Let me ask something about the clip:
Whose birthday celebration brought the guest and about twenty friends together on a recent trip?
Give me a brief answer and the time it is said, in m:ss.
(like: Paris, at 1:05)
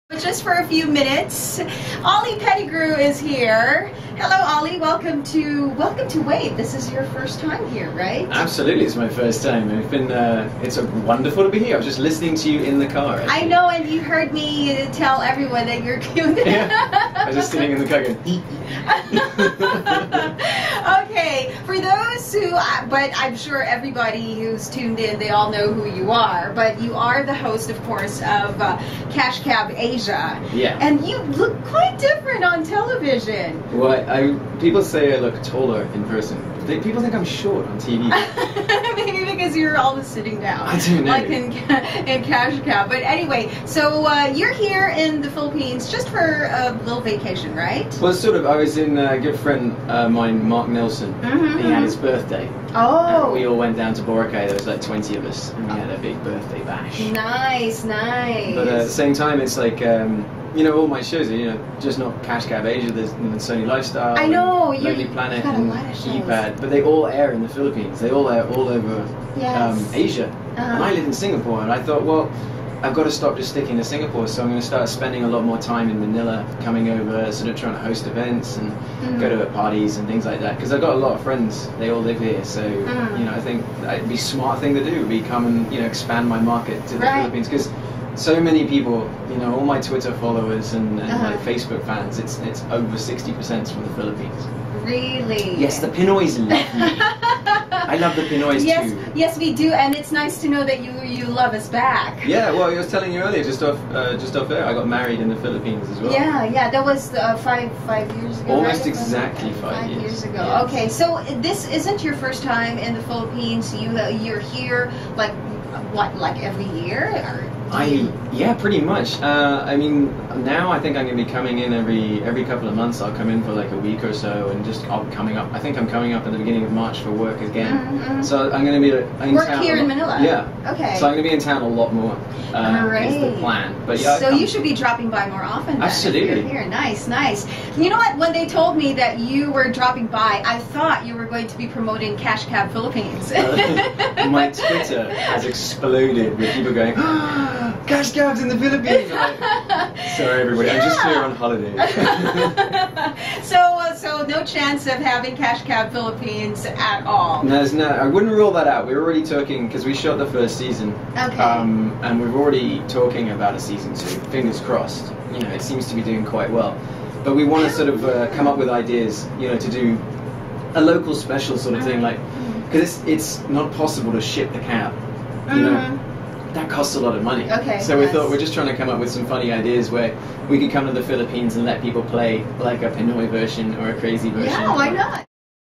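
Mark Nelson, at 0:50.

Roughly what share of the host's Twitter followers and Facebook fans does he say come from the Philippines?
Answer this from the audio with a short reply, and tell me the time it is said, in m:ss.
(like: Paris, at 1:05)
over 60%, at 1:32.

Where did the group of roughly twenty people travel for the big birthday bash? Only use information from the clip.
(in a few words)
Boracay.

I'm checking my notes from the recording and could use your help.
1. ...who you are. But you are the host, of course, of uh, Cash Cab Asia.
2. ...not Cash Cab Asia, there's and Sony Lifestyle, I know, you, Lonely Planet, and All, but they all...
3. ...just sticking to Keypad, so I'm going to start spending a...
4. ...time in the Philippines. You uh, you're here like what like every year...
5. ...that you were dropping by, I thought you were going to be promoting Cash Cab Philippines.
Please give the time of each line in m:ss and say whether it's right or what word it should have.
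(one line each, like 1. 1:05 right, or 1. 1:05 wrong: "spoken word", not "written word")
1. 0:25 right
2. 1:01 wrong: "Keypad", not "All"
3. 1:13 wrong: "Singapore", not "Keypad"
4. 1:52 right
5. 2:18 right.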